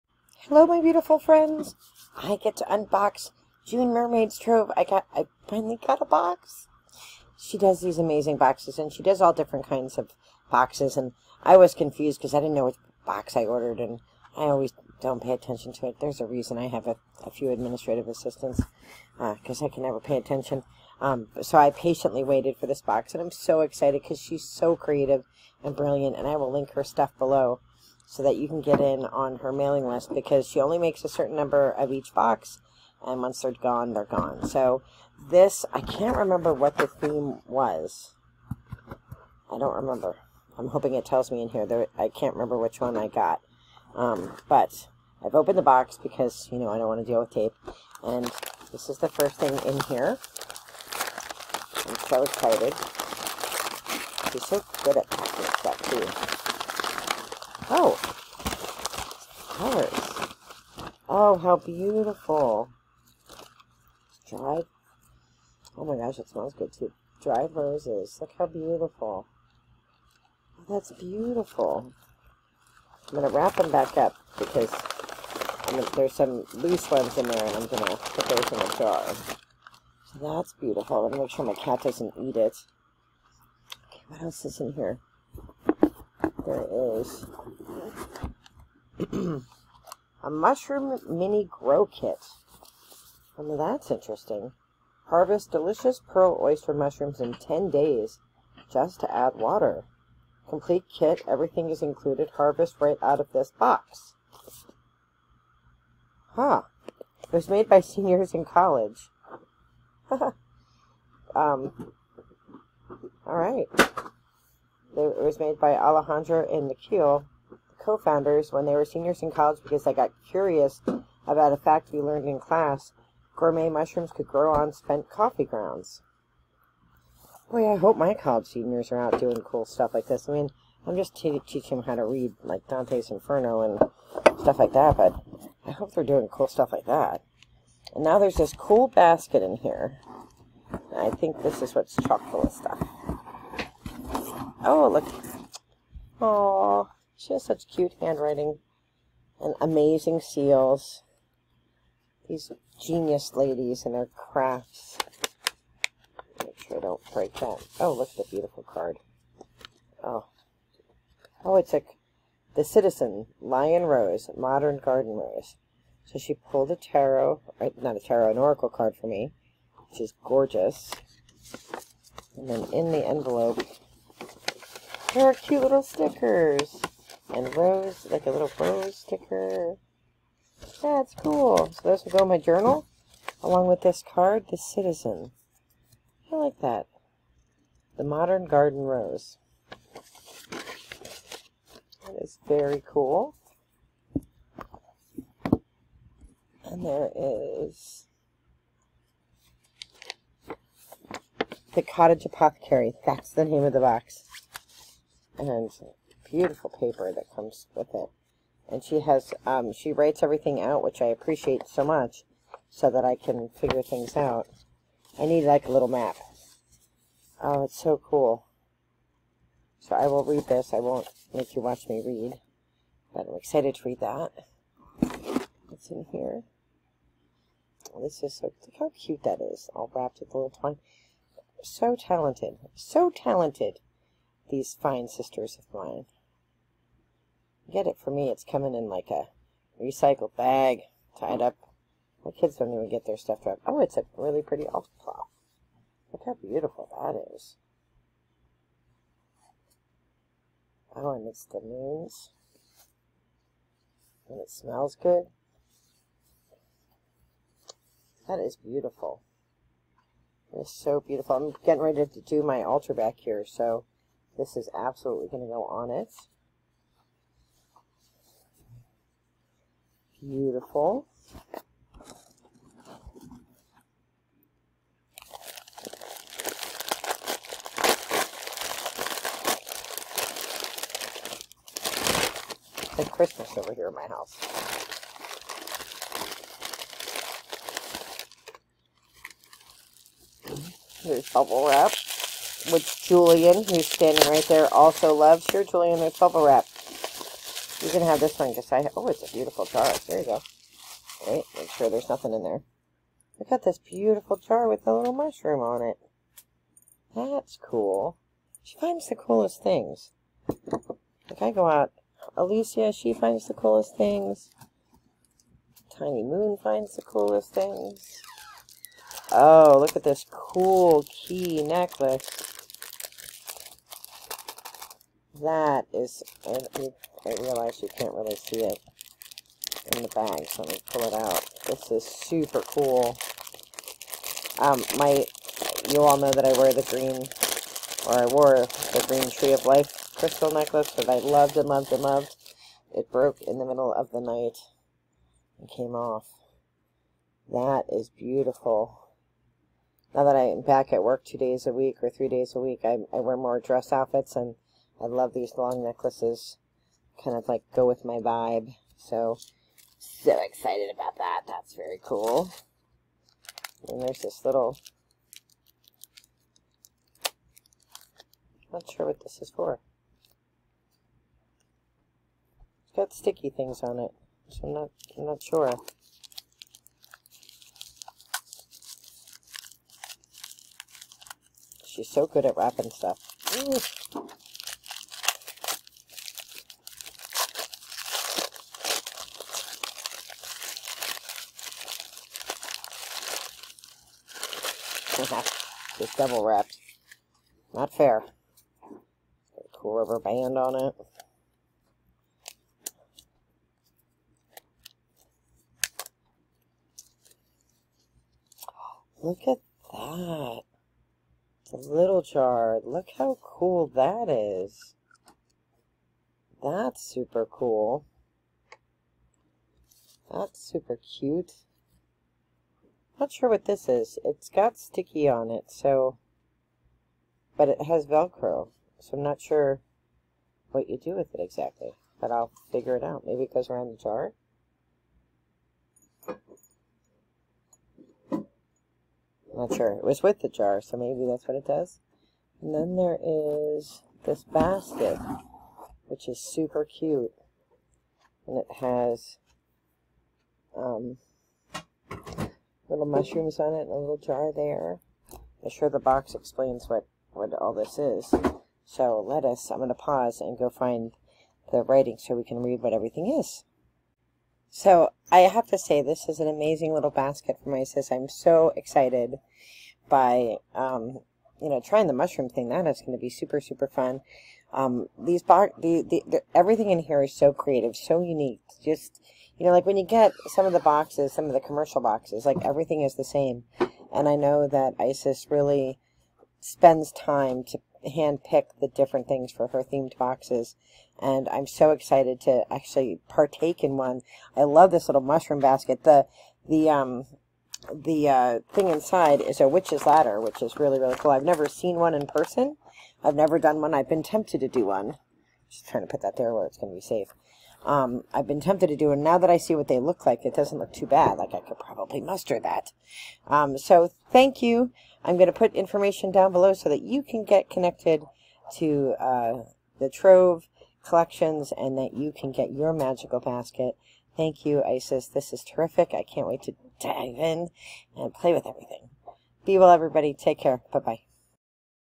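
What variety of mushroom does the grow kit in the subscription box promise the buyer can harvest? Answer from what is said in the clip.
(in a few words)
Pearl oyster.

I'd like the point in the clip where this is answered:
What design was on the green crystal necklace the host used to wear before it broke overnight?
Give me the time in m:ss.
5:39.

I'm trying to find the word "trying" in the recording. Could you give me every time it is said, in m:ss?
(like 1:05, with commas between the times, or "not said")
7:51, 8:25.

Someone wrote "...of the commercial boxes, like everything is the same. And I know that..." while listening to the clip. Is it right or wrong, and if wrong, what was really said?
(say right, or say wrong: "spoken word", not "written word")
right.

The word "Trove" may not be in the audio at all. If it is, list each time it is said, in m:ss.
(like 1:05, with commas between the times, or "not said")
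0:04, 8:40.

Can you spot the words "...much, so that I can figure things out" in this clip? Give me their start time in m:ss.
3:31.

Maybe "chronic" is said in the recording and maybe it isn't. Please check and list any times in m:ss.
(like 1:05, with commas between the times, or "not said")
not said.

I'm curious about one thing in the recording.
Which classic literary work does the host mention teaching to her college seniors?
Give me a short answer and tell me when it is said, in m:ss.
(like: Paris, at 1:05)
Dante's Inferno, at 2:12.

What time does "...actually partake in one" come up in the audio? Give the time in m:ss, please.
8:12.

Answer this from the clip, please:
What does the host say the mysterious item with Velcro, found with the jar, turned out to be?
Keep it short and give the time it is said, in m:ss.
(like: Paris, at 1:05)
A witch's ladder, at 8:19.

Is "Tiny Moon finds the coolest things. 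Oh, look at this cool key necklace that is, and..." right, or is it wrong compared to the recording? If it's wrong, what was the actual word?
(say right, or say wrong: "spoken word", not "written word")
right.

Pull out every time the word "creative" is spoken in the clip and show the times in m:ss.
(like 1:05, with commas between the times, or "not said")
0:24, 7:57.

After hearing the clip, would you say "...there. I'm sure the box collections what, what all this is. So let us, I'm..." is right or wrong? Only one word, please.
wrong.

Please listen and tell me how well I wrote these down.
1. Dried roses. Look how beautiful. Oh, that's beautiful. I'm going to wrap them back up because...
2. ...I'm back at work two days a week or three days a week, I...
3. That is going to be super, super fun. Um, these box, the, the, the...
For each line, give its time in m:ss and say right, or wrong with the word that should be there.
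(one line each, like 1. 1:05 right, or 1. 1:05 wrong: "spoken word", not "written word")
1. 1:07 right
2. 5:50 right
3. 7:52 right.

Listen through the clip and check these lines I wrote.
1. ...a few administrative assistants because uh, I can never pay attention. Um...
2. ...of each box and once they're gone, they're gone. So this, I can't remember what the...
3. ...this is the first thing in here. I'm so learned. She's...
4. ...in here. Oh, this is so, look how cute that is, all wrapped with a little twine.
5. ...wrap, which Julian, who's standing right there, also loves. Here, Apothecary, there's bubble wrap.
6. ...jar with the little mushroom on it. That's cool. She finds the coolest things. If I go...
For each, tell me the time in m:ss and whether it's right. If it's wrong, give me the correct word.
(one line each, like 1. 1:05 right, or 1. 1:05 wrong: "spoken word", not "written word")
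1. 0:17 right
2. 0:31 right
3. 0:48 wrong: "excited", not "learned"
4. 3:45 right
5. 4:51 wrong: "Julian", not "Apothecary"
6. 5:04 right.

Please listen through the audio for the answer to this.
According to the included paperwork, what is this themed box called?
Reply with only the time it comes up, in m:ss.
3:21.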